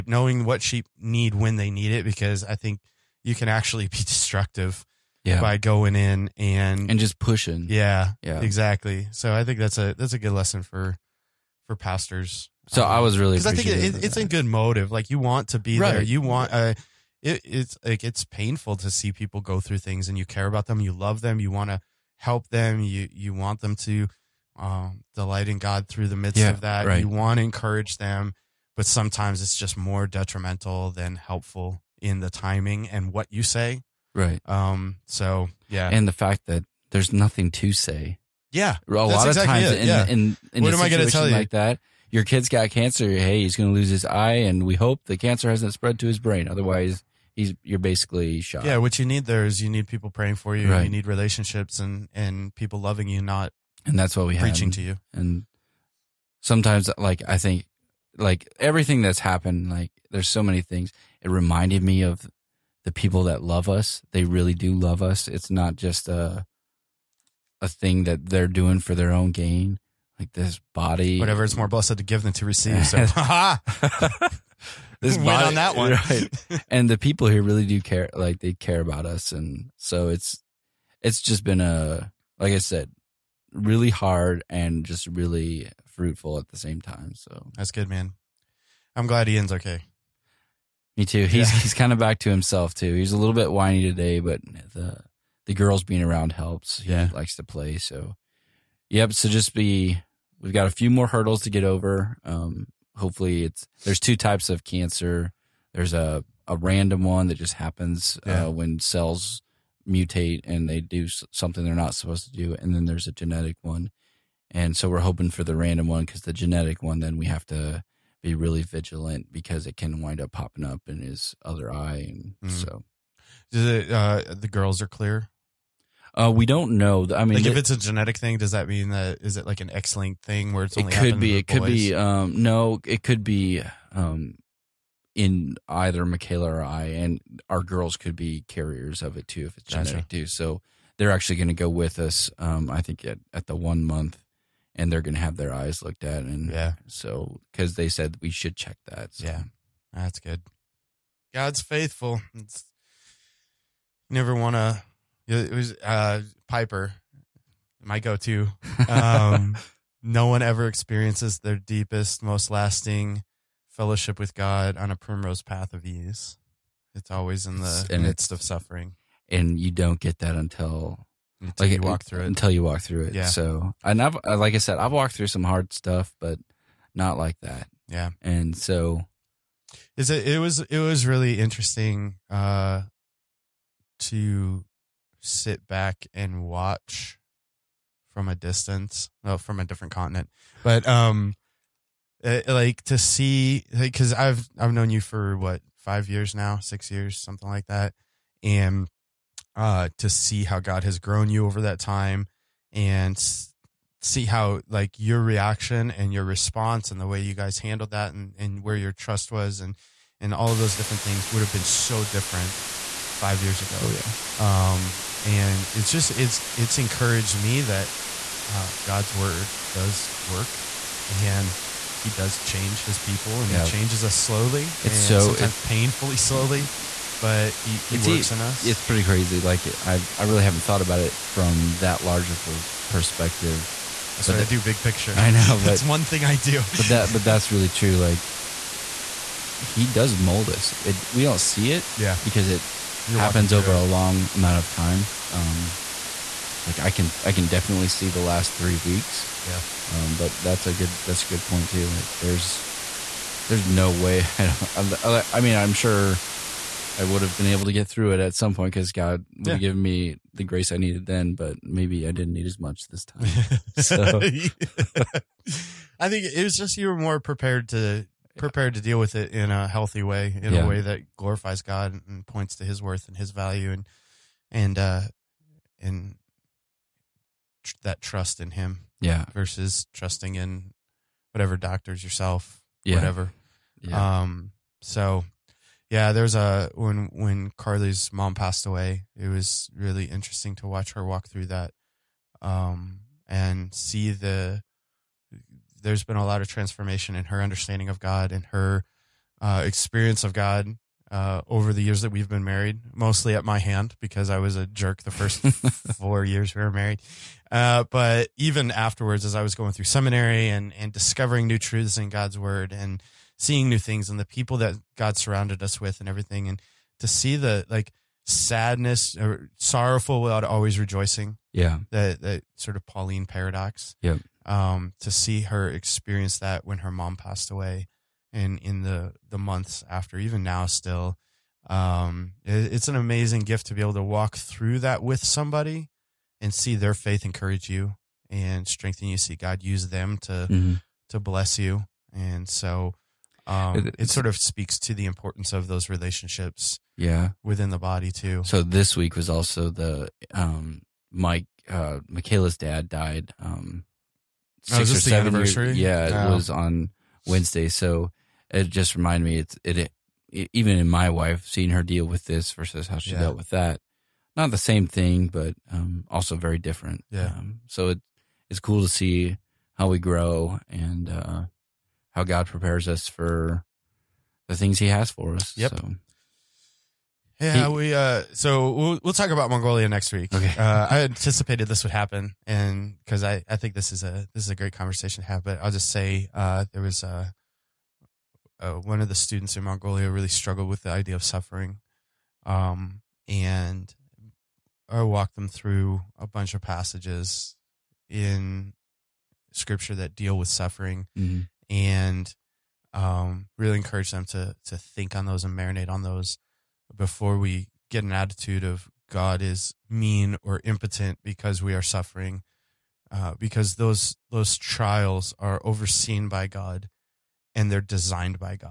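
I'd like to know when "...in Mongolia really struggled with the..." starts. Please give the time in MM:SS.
06:29.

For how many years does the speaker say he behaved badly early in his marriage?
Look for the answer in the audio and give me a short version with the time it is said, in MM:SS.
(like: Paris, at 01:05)
4, at 05:05.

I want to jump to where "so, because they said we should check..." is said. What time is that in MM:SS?
02:26.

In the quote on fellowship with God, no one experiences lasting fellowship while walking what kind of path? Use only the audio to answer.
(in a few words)
primrose path.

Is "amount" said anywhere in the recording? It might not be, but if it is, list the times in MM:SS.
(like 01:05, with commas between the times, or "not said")
04:04.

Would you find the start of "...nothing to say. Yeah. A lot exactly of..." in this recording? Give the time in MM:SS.
00:37.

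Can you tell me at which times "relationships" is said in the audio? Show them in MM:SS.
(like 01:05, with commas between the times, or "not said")
00:51, 05:45.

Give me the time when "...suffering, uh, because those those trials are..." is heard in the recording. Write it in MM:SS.
06:51.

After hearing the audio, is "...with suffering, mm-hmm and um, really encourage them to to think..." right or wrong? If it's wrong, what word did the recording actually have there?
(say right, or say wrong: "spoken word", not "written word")
right.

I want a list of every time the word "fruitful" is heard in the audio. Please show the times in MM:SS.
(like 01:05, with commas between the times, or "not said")
01:25.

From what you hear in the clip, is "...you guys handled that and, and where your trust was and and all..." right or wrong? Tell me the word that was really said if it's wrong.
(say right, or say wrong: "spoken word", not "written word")
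right.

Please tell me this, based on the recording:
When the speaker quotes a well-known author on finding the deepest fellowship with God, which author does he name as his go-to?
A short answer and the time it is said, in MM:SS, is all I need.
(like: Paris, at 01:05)
Piper, at 02:36.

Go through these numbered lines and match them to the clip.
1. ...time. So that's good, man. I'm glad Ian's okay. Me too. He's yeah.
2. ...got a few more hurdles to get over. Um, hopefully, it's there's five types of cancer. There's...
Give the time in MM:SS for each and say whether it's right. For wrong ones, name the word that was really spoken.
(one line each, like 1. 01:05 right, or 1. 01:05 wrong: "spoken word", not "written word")
1. 01:26 right
2. 01:40 wrong: "two", not "five".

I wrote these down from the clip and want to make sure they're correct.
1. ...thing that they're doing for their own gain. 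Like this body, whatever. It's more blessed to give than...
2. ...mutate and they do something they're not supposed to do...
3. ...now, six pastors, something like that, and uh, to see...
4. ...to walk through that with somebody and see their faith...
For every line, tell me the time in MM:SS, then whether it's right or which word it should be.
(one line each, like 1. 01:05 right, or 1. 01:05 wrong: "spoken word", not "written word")
1. 01:07 right
2. 01:49 right
3. 03:16 wrong: "years", not "pastors"
4. 05:33 right.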